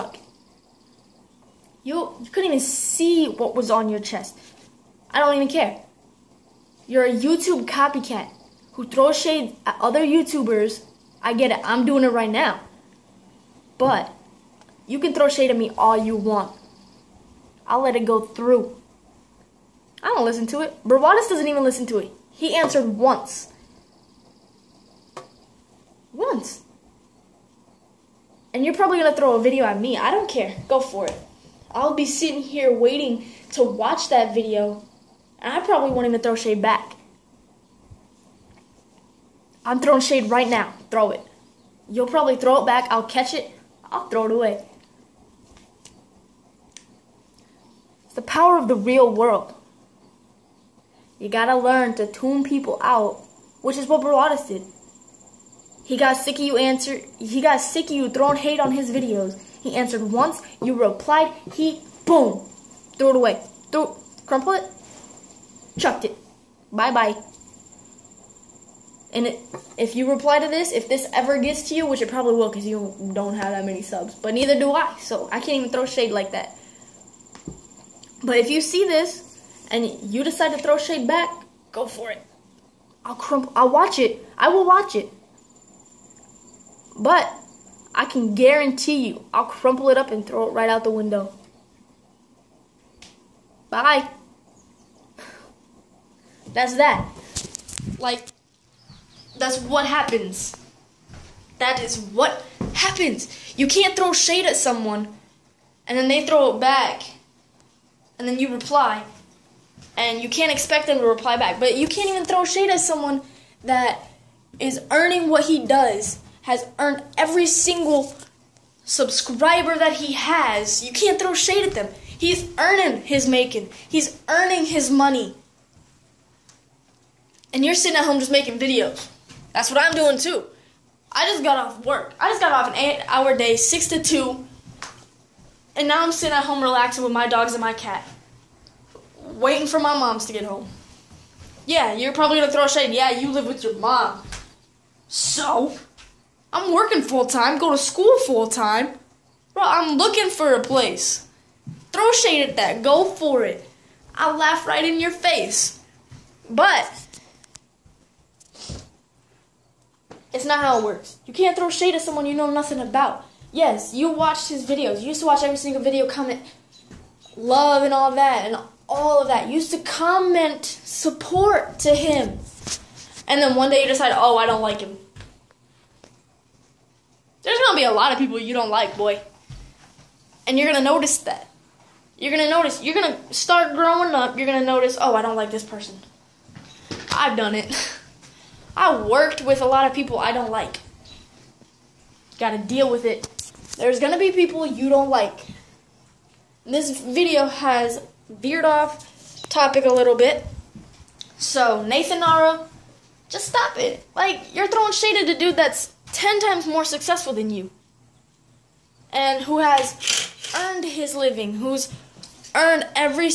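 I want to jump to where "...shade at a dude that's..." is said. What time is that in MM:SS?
03:24.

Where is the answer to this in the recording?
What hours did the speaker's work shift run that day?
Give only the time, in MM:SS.
02:13.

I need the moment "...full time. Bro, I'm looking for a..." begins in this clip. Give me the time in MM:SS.
02:28.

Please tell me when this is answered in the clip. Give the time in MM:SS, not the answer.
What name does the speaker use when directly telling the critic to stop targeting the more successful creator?
03:21.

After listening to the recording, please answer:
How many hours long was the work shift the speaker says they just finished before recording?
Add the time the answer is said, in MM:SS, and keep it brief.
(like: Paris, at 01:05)
8, at 02:12.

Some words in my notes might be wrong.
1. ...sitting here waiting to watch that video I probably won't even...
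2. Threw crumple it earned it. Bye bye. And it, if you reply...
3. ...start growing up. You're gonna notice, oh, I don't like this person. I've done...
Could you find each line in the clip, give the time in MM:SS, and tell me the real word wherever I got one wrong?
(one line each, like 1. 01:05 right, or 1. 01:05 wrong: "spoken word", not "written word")
1. 00:32 right
2. 01:03 wrong: "chucked", not "earned"
3. 03:03 right.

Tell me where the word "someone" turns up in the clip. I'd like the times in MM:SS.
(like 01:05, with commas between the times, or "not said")
01:44, 01:52, 02:42.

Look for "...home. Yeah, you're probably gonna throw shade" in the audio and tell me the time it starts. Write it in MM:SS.
02:20.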